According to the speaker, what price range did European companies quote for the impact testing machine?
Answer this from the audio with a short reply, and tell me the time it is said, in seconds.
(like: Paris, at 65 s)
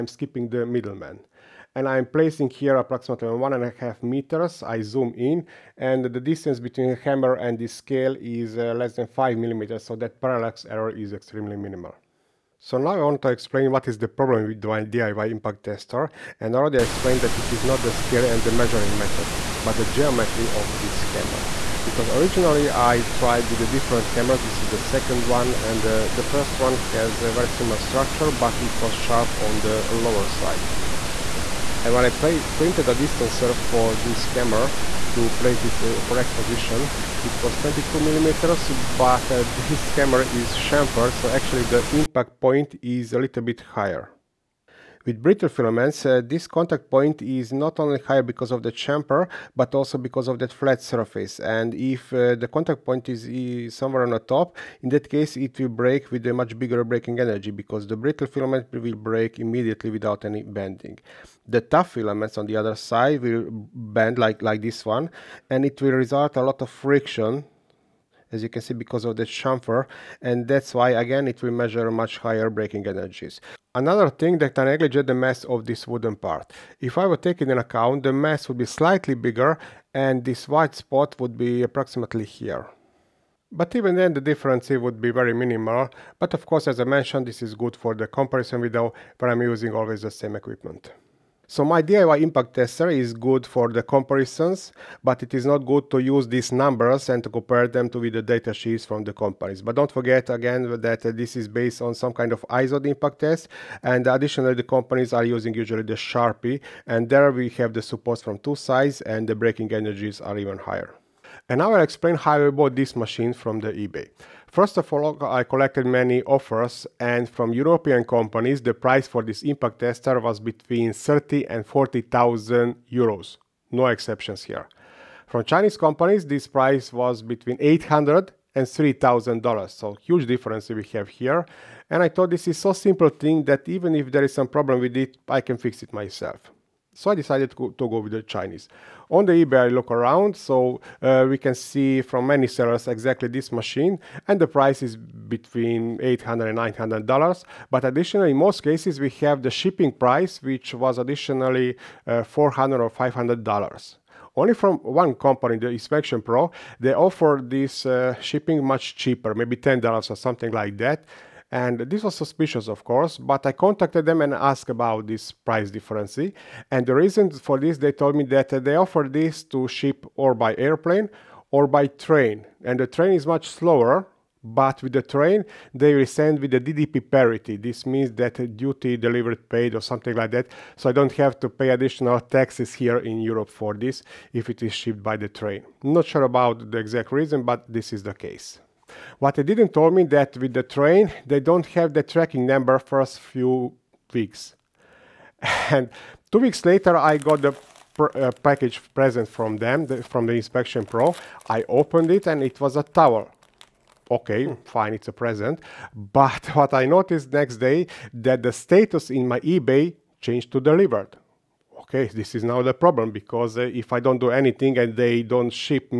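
30,000 to 40,000 euros, at 120 s.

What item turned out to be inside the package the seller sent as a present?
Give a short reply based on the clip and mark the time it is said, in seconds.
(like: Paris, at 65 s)
A towel, at 202 s.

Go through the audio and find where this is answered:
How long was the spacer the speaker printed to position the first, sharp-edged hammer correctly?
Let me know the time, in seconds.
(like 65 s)
37 s.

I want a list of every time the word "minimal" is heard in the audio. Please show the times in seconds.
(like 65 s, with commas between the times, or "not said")
11 s, 85 s.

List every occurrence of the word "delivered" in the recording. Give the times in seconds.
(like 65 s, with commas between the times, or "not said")
178 s, 210 s.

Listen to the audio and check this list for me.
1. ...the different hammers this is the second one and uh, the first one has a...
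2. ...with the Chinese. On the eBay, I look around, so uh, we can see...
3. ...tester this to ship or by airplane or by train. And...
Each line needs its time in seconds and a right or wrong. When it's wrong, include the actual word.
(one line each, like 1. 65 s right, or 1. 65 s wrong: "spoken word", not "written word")
1. 23 s right
2. 137 s right
3. 168 s wrong: "offer", not "tester".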